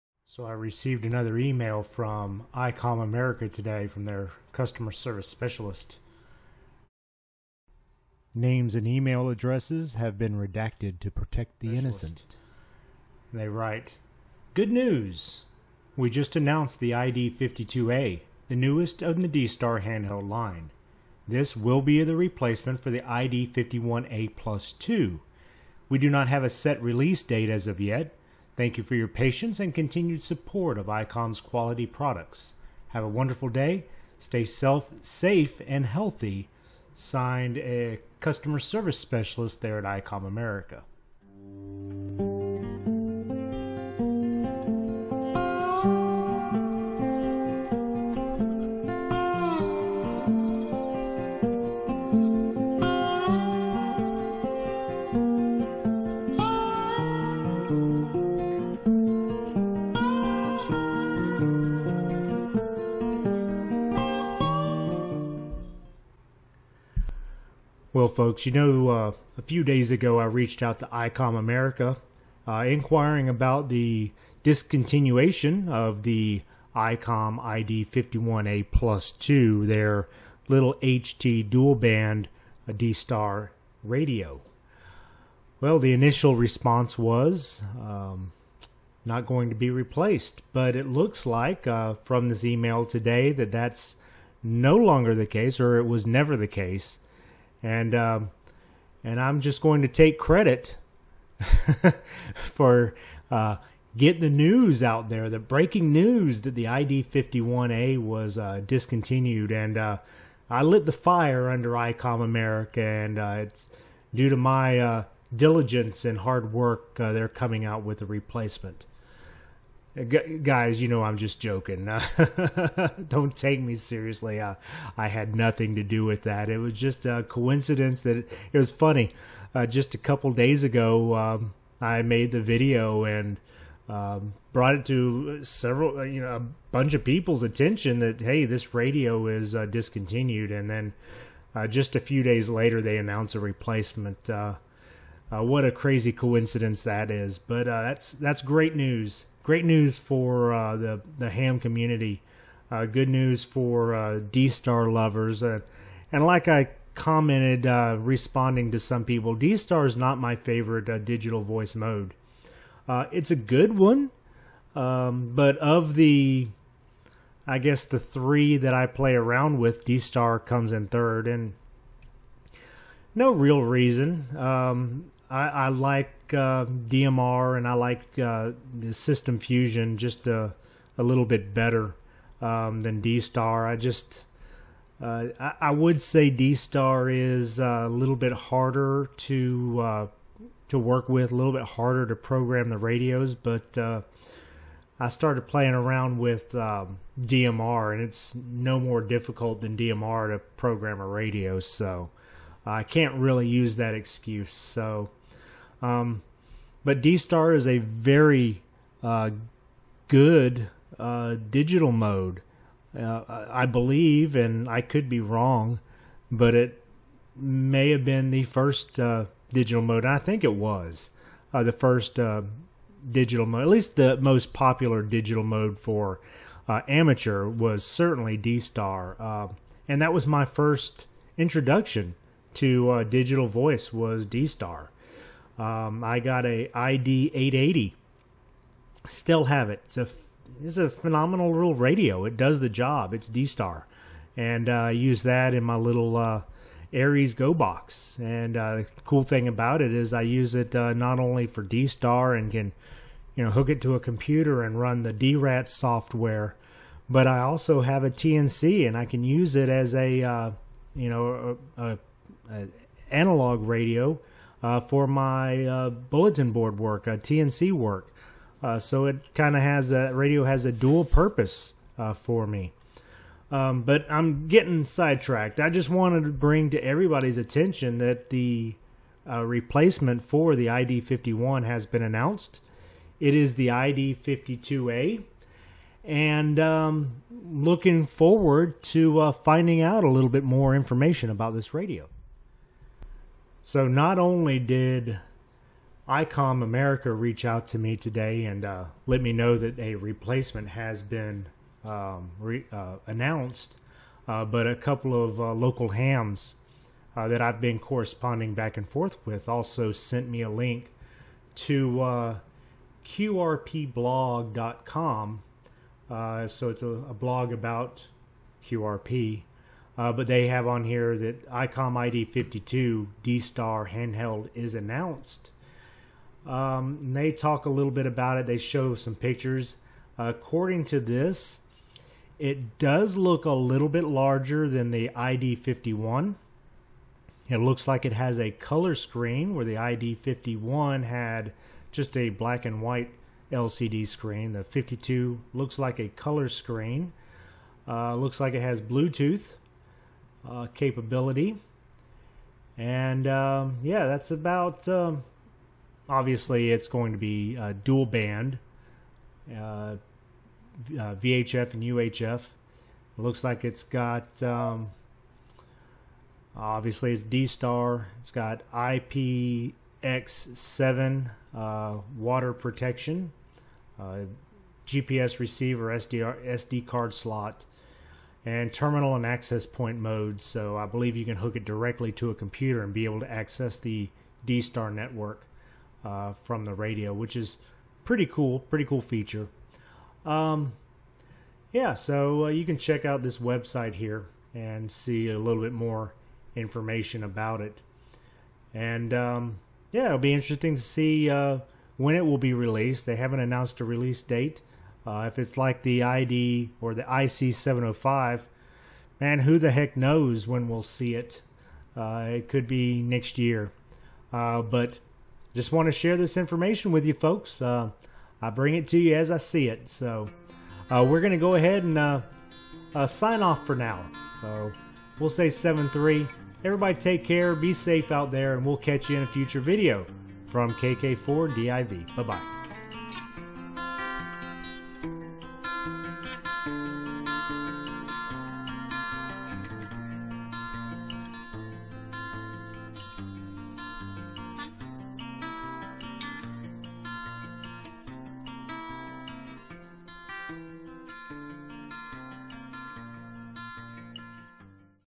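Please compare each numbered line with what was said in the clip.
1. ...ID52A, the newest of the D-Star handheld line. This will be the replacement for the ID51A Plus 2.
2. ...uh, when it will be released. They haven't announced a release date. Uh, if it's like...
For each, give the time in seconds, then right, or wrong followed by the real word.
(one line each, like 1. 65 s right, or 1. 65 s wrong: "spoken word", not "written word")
1. 16 s right
2. 401 s right.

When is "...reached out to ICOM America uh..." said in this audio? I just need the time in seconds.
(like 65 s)
70 s.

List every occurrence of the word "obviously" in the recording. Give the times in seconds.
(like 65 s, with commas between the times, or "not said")
356 s, 366 s.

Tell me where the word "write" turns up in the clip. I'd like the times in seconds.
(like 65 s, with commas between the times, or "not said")
13 s.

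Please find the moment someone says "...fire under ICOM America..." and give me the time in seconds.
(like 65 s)
110 s.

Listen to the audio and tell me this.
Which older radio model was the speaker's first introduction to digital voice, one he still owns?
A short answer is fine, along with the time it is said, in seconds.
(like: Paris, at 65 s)
ID 880, at 236 s.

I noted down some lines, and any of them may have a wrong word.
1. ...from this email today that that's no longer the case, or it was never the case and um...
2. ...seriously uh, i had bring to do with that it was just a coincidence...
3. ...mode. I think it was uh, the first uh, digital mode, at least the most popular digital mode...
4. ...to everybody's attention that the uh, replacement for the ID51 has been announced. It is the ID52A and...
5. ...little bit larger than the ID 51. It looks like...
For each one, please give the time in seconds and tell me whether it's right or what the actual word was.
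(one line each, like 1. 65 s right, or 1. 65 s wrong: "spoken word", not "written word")
1. 92 s right
2. 123 s wrong: "nothing", not "bring"
3. 219 s right
4. 276 s right
5. 333 s right.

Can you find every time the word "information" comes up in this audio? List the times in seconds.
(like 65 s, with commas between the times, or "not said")
290 s, 396 s, 416 s.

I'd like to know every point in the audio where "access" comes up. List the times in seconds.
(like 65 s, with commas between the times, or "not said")
379 s, 383 s.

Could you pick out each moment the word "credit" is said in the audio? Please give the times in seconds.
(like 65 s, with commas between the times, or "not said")
100 s.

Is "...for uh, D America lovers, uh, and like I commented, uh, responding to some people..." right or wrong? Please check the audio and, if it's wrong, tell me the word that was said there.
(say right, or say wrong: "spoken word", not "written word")
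wrong: "Star", not "America".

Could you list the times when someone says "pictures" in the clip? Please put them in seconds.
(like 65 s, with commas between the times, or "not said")
329 s.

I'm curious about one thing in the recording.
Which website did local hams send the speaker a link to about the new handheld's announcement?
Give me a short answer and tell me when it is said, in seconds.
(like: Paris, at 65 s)
QRPblog.com, at 313 s.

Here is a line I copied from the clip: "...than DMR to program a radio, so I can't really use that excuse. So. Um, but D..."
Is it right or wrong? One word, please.
right.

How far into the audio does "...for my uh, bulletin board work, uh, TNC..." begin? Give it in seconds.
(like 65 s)
264 s.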